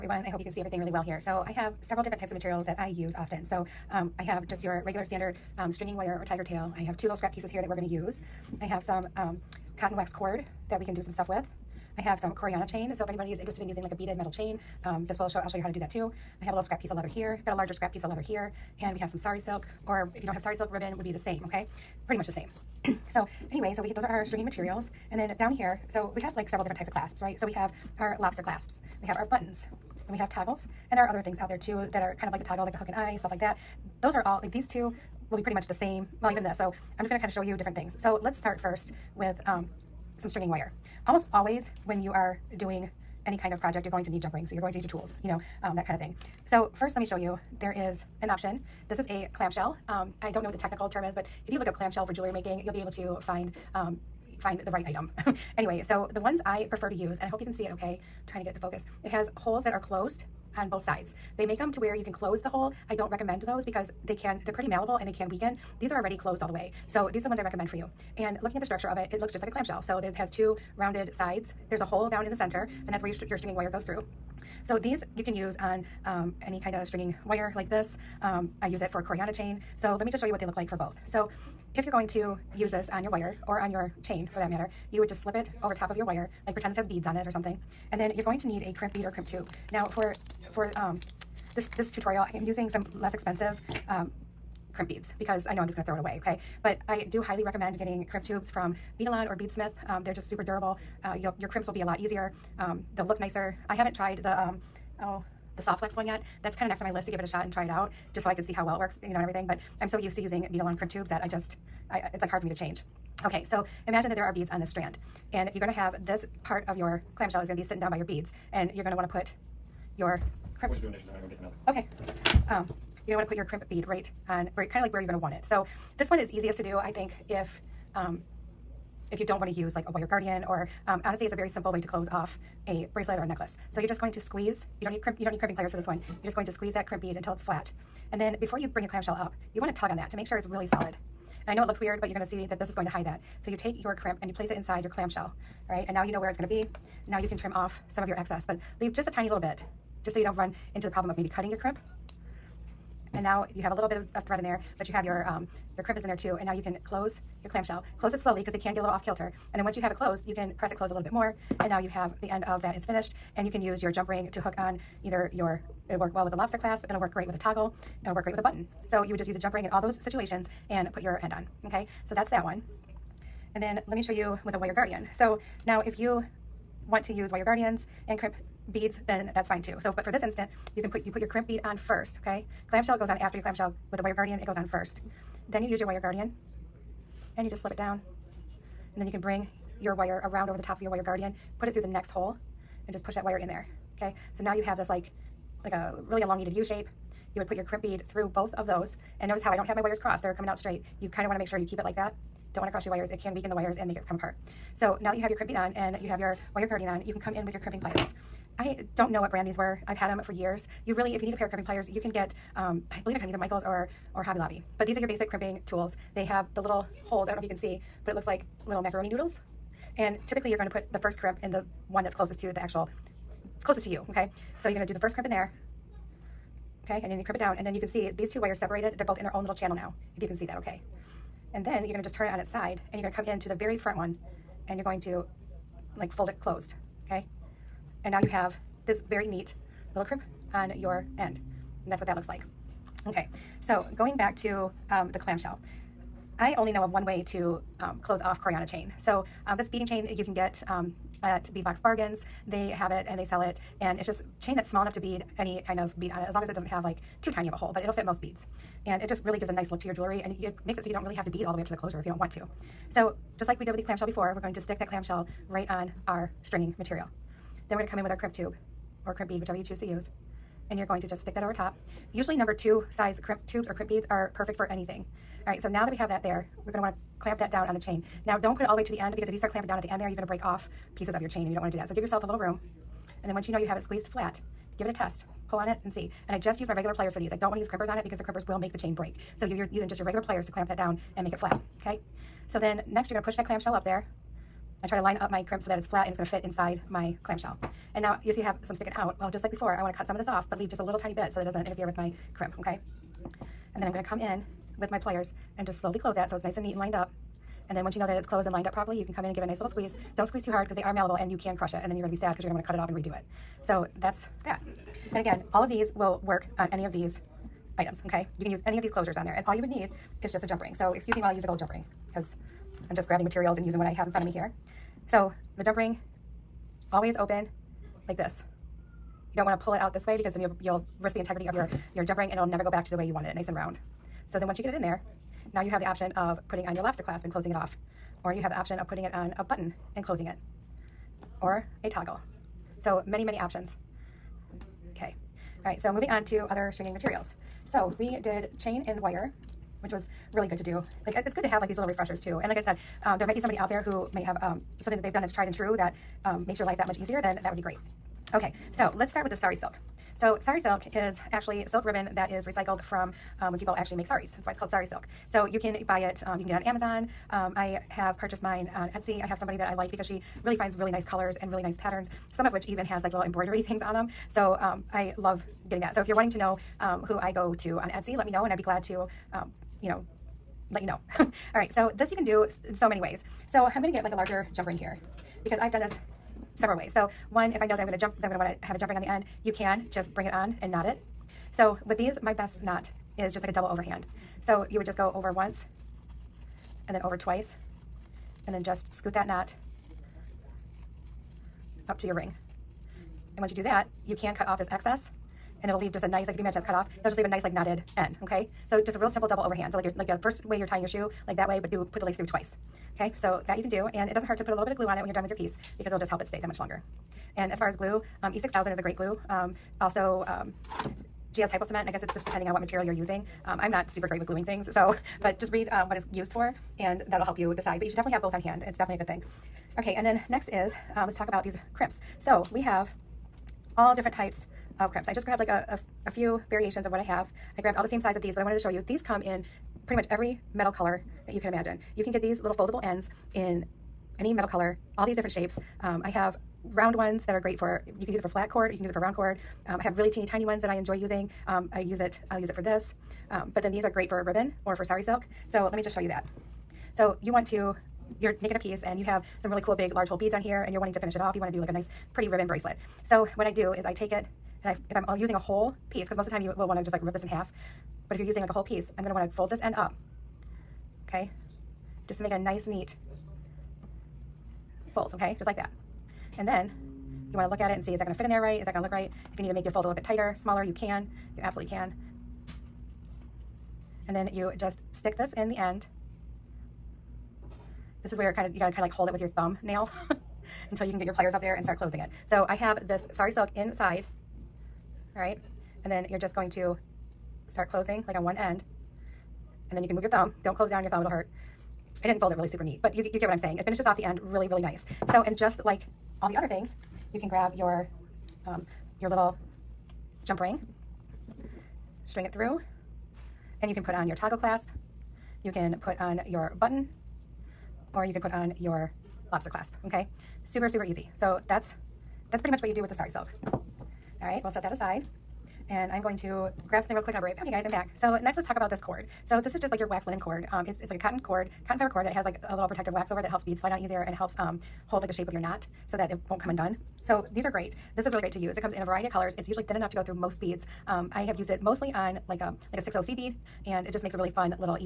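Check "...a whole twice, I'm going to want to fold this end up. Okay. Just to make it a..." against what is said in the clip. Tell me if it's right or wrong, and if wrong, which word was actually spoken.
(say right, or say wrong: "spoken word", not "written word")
wrong: "piece", not "twice".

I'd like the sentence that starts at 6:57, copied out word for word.
And as far as glue, um, E6000 is a great glue.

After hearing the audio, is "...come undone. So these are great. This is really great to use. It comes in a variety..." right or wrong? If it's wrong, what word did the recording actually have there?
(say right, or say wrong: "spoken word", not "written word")
right.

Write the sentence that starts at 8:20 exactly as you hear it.
Don't close it down on your thumb, it'll hurt.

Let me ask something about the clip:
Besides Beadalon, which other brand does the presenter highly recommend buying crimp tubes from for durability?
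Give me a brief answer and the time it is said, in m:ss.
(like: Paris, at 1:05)
Beadsmith, at 1:39.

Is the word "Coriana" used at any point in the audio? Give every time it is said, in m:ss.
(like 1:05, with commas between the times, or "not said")
0:12, 1:19, 4:08.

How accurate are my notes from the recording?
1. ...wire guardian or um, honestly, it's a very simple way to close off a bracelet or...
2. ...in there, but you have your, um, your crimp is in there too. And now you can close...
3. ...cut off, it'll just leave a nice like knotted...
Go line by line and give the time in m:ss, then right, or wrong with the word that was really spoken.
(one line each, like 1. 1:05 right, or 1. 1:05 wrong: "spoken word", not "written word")
1. 2:09 right
2. 2:34 right
3. 6:46 right.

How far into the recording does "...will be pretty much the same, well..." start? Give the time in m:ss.
0:35.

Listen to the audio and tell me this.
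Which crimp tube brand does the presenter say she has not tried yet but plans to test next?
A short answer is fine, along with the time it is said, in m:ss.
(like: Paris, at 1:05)
Softflex, at 1:45.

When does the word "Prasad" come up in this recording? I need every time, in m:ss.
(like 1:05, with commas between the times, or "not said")
not said.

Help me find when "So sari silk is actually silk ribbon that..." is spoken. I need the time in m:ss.
6:00.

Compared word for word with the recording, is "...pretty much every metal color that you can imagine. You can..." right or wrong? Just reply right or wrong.
right.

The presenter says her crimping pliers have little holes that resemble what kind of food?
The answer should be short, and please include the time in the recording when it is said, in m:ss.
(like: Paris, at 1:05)
macaroni noodles, at 3:38.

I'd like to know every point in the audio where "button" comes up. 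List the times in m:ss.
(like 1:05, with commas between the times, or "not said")
0:29, 2:48, 5:39, 8:36.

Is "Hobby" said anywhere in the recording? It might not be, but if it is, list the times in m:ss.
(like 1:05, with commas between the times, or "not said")
3:34.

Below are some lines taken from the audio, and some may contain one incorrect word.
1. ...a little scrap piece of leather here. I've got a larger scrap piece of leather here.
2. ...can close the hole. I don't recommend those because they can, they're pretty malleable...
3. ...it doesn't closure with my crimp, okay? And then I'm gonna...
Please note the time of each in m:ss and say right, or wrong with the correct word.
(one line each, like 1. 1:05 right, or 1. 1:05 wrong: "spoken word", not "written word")
1. 0:16 right
2. 1:02 right
3. 5:01 wrong: "interfere", not "closure".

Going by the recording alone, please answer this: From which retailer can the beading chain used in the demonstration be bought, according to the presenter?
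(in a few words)
Bead Box Bargains.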